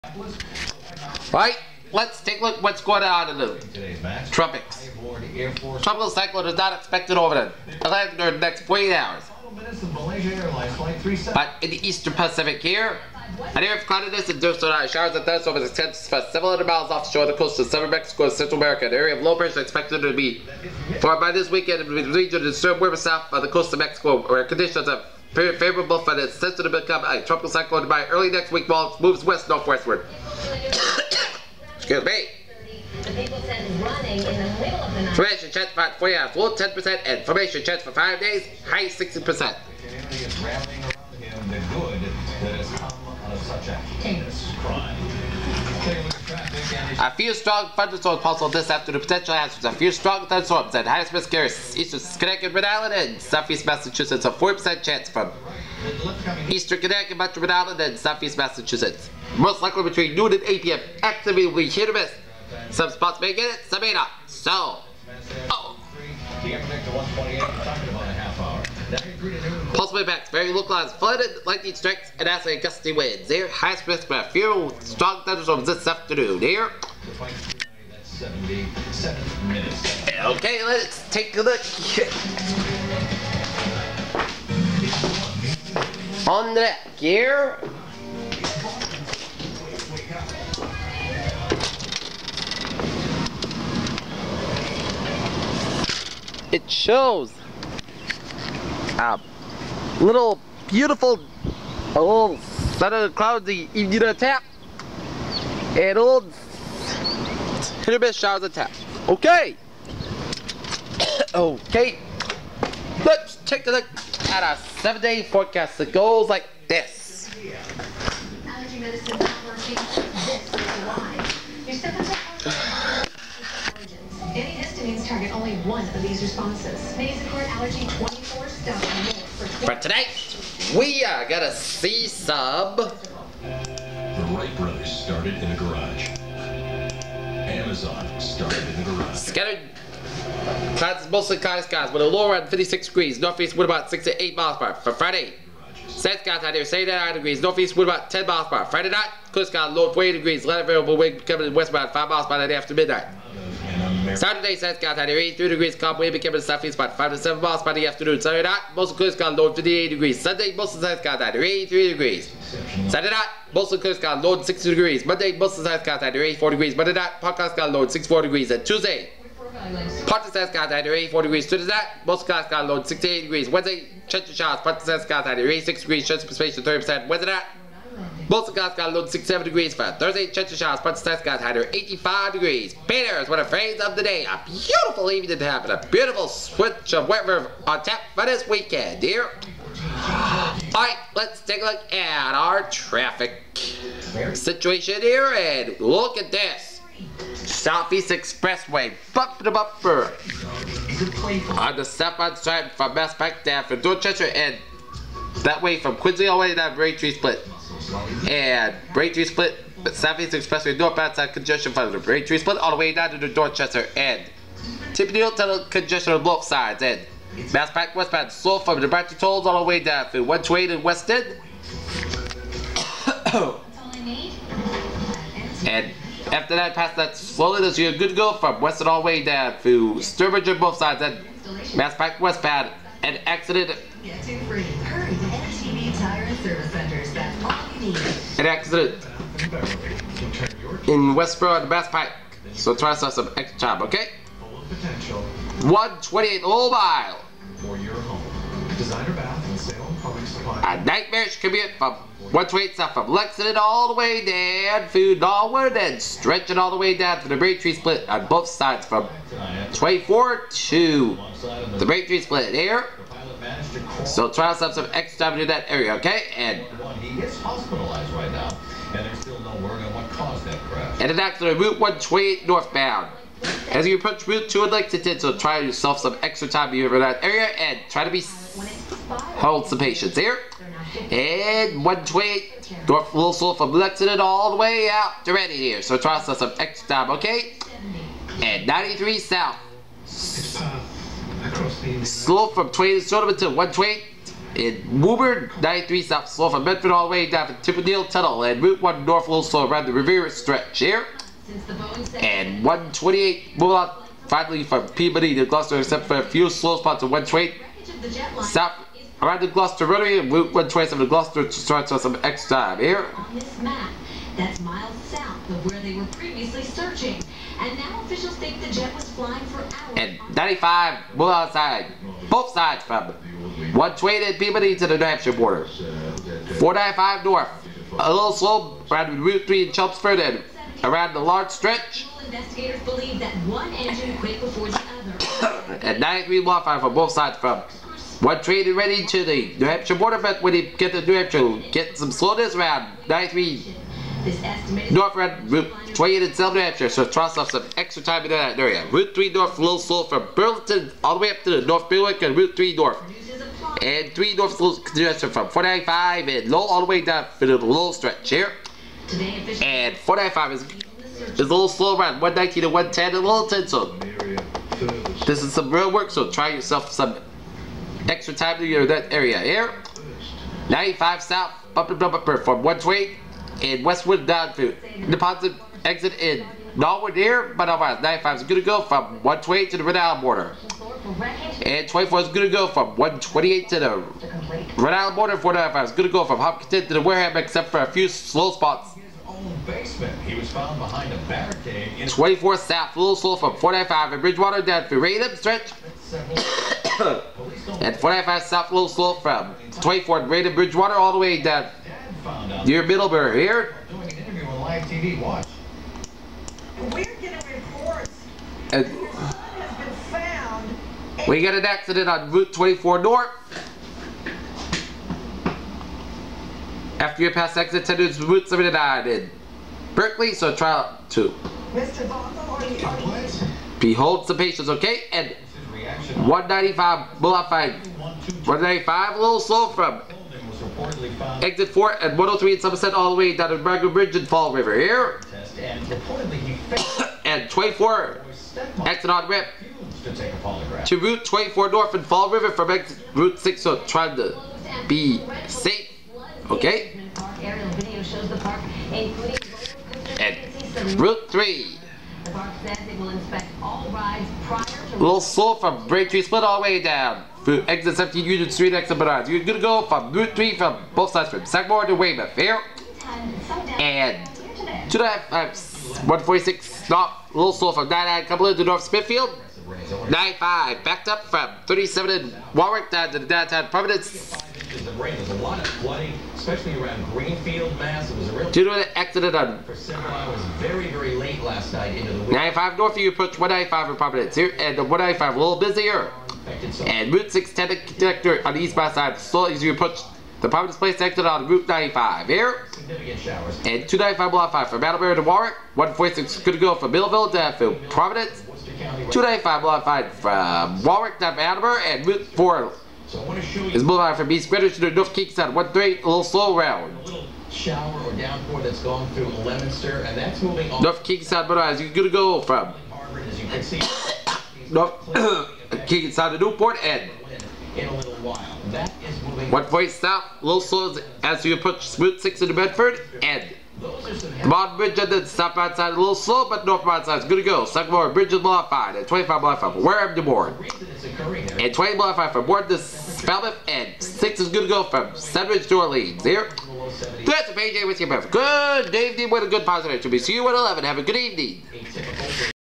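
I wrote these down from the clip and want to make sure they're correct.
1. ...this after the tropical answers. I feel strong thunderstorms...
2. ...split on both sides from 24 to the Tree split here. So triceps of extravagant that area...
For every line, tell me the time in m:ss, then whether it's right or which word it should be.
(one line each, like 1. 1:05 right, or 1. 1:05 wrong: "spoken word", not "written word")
1. 0:48 wrong: "potential", not "tropical"
2. 4:17 right.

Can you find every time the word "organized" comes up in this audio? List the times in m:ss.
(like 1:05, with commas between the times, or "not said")
not said.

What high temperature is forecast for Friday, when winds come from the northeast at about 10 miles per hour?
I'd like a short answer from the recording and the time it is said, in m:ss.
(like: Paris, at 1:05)
79 degrees, at 2:26.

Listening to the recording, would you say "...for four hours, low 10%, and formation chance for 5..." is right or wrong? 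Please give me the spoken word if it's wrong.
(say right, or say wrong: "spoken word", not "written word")
right.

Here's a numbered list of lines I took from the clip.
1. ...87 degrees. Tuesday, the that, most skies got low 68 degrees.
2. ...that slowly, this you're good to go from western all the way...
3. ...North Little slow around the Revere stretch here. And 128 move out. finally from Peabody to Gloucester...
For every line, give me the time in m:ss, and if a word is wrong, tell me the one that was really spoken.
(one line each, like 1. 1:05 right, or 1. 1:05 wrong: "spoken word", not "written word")
1. 2:50 wrong: "84", not "87"
2. 3:46 right
3. 4:59 right.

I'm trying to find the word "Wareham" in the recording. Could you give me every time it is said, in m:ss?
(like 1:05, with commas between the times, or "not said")
6:27, 8:49.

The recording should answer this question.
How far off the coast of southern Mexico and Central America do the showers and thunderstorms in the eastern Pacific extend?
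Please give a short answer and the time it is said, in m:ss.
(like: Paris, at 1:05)
700 miles, at 0:16.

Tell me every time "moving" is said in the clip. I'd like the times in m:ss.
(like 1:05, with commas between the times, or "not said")
8:30.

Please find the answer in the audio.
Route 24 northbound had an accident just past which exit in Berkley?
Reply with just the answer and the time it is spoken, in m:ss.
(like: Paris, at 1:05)
Exit 10, at 6:57.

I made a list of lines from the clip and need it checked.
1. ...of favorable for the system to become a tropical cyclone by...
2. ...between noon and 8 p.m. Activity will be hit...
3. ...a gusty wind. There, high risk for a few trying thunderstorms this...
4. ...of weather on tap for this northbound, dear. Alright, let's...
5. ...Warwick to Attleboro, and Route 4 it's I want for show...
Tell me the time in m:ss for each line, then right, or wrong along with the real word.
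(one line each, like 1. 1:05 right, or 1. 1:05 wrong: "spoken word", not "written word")
1. 0:24 right
2. 0:59 right
3. 1:12 wrong: "strong", not "trying"
4. 3:06 wrong: "weekend", not "northbound"
5. 8:20 right.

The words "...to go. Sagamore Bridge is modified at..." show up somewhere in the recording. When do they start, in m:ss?
8:47.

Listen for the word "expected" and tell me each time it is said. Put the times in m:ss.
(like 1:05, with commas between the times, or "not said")
0:06, 0:19.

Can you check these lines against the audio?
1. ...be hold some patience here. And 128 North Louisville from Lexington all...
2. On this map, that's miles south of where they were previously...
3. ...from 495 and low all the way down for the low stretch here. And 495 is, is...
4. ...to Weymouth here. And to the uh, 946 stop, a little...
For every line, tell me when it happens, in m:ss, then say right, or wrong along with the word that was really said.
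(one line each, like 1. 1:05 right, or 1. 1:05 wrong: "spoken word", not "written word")
1. 4:38 right
2. 5:13 right
3. 5:55 right
4. 7:41 wrong: "146", not "946".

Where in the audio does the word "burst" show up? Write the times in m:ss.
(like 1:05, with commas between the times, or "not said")
not said.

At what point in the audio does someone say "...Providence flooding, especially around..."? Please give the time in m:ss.
7:53.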